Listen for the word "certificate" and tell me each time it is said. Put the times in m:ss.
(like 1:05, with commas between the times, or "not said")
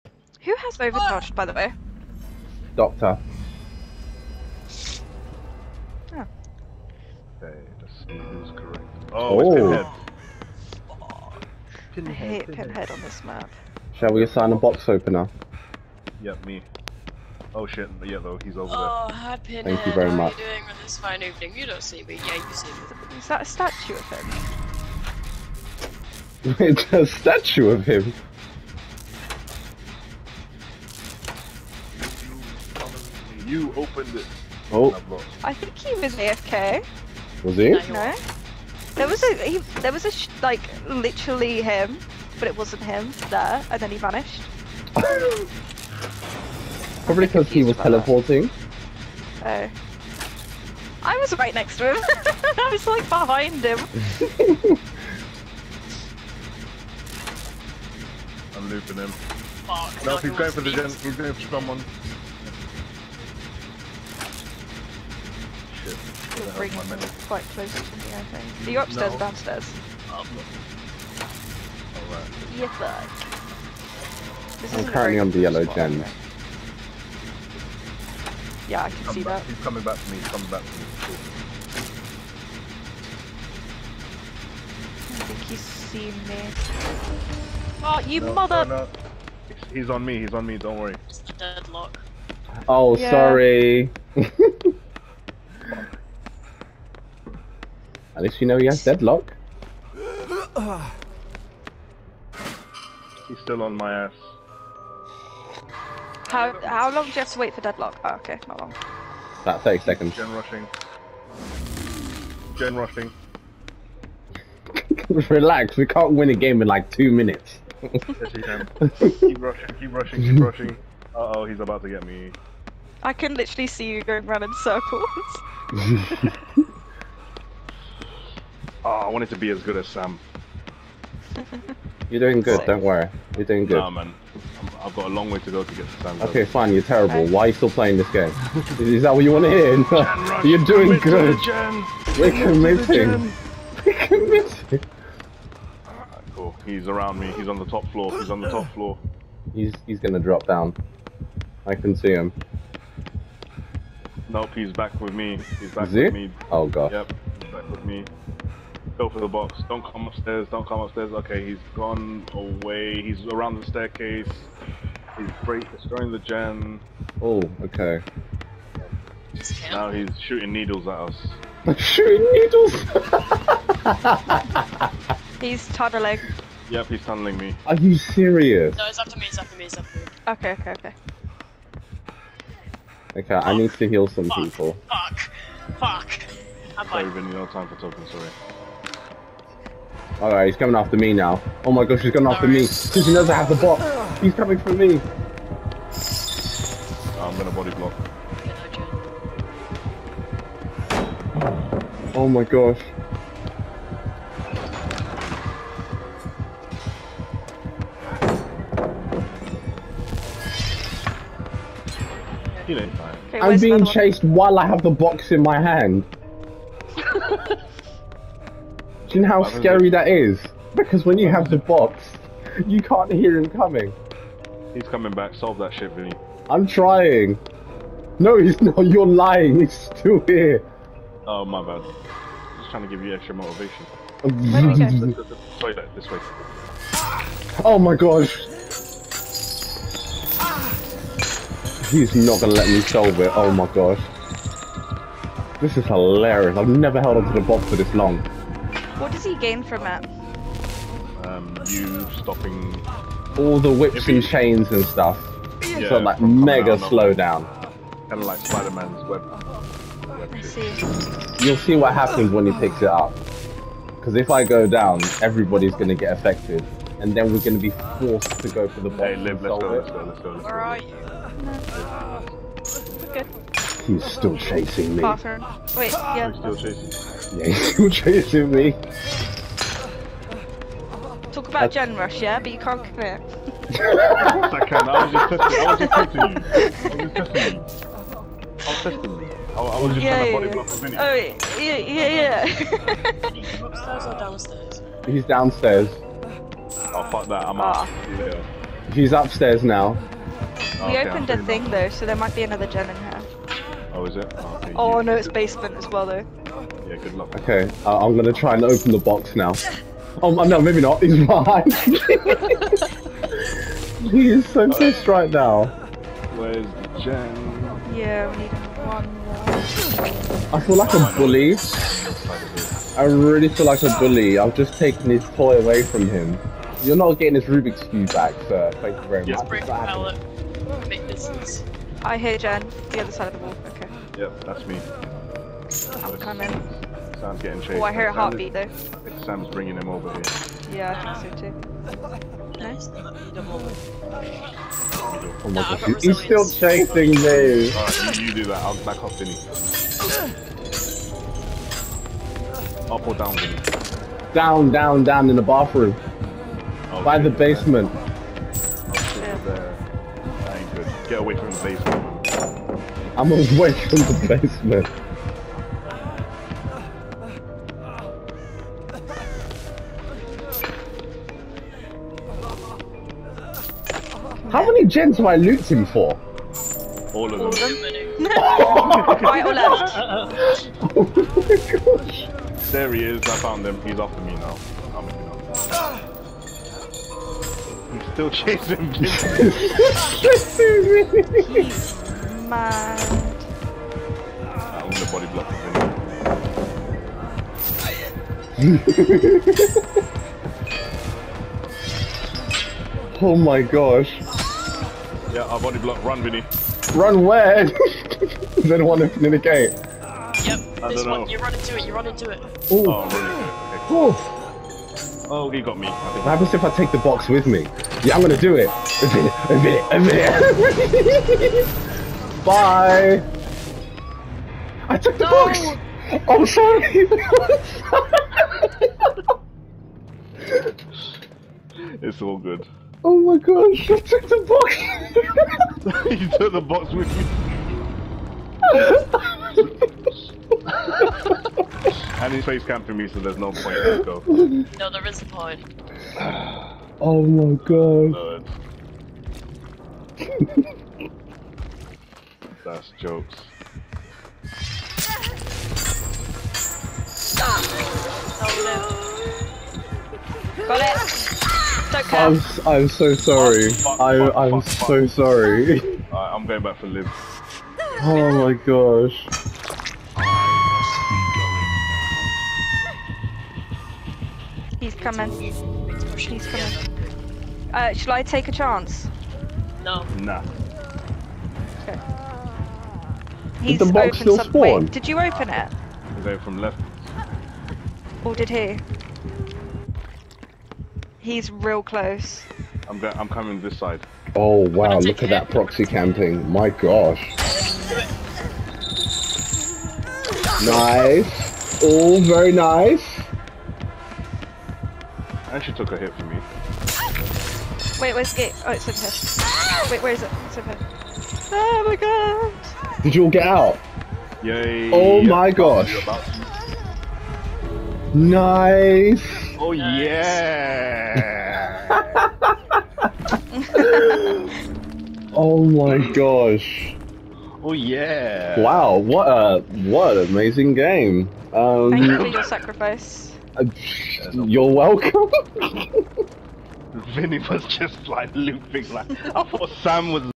not said.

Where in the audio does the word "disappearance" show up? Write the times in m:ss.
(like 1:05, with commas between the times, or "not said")
not said.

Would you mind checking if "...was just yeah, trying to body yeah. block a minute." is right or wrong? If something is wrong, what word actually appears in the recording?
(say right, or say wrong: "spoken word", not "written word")
right.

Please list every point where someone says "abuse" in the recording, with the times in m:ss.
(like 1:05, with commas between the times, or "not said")
not said.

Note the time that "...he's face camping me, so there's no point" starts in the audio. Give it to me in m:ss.
7:22.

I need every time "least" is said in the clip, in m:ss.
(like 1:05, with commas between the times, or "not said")
1:38.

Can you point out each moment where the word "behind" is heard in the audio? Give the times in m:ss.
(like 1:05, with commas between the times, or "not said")
0:53, 5:11.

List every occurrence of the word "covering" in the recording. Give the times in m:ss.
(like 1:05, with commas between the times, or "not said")
not said.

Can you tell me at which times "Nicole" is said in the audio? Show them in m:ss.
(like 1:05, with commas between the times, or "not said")
not said.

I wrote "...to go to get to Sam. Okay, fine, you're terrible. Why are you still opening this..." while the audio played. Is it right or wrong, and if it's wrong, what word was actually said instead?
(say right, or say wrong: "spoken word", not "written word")
wrong: "playing", not "opening".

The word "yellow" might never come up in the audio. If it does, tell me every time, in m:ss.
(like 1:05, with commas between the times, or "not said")
0:18, 1:15.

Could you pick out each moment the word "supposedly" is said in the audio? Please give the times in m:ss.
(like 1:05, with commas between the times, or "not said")
not said.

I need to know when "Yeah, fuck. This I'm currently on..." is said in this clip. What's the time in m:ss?
1:12.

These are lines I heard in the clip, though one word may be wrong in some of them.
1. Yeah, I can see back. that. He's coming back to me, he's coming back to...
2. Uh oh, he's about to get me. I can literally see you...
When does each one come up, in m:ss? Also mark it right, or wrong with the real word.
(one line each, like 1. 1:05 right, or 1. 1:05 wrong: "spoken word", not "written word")
1. 1:18 right
2. 2:01 right.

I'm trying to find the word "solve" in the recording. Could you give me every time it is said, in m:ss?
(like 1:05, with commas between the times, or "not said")
3:45, 4:02.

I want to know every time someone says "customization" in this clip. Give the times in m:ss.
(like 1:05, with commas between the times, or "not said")
not said.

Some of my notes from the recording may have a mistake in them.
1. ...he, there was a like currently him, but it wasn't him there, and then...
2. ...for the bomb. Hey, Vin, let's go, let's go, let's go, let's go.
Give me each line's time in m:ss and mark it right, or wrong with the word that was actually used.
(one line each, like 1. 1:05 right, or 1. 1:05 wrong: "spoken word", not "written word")
1. 0:39 wrong: "literally", not "currently"
2. 4:28 wrong: "Liv", not "Vin".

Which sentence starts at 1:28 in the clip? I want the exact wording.
No, he's on me, he's on me, don't worry.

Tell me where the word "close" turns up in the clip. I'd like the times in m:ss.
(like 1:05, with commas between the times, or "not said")
1:07, 8:11.